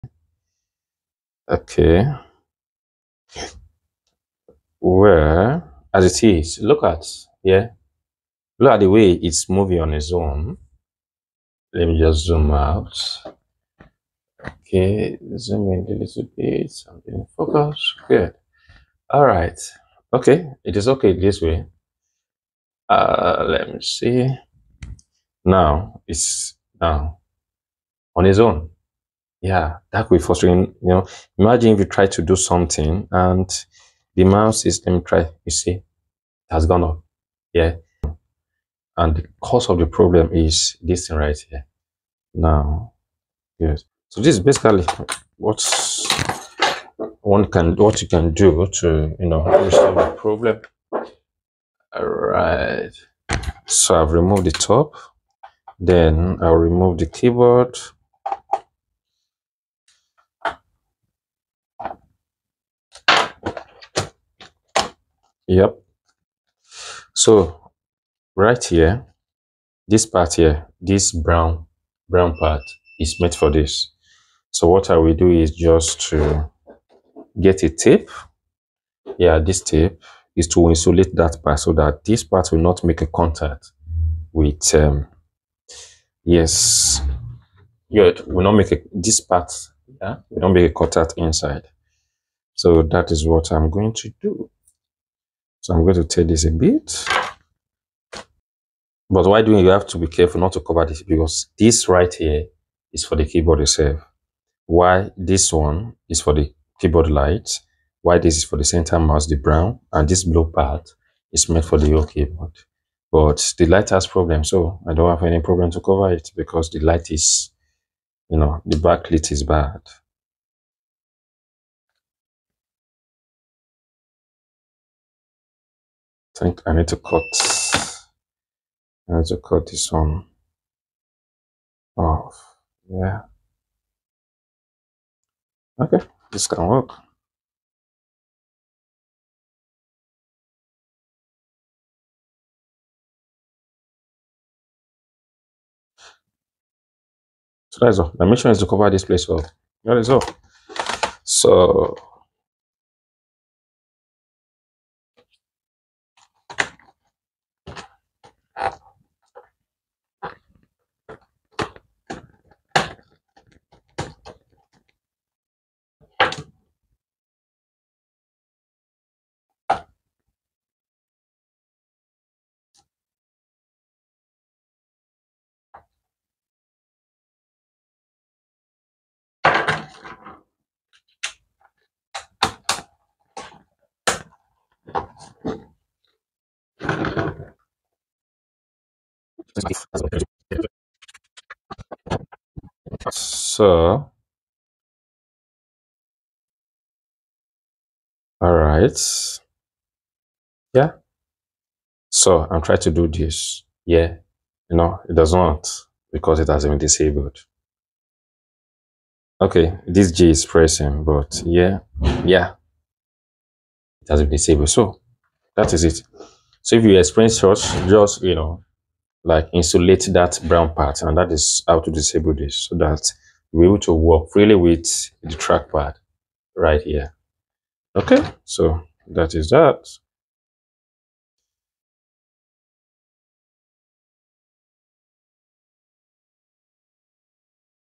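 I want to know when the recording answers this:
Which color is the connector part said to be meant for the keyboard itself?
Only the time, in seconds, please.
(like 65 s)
110 s.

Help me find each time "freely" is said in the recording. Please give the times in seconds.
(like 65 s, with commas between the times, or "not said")
224 s.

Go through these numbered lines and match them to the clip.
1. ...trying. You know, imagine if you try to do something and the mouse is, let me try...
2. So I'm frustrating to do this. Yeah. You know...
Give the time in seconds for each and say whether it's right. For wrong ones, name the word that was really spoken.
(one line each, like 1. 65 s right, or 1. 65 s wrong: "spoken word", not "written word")
1. 30 s wrong: "frustrating", not "trying"
2. 202 s wrong: "trying", not "frustrating".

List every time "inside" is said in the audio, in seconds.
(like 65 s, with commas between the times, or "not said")
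91 s.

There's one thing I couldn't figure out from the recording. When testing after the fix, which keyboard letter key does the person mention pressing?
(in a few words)
J.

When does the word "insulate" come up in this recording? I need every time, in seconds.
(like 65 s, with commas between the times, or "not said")
80 s, 219 s.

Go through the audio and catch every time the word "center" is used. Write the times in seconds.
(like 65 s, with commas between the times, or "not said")
108 s.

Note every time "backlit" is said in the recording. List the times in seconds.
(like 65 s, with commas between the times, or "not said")
118 s.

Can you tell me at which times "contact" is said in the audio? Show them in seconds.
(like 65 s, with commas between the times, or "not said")
83 s, 90 s.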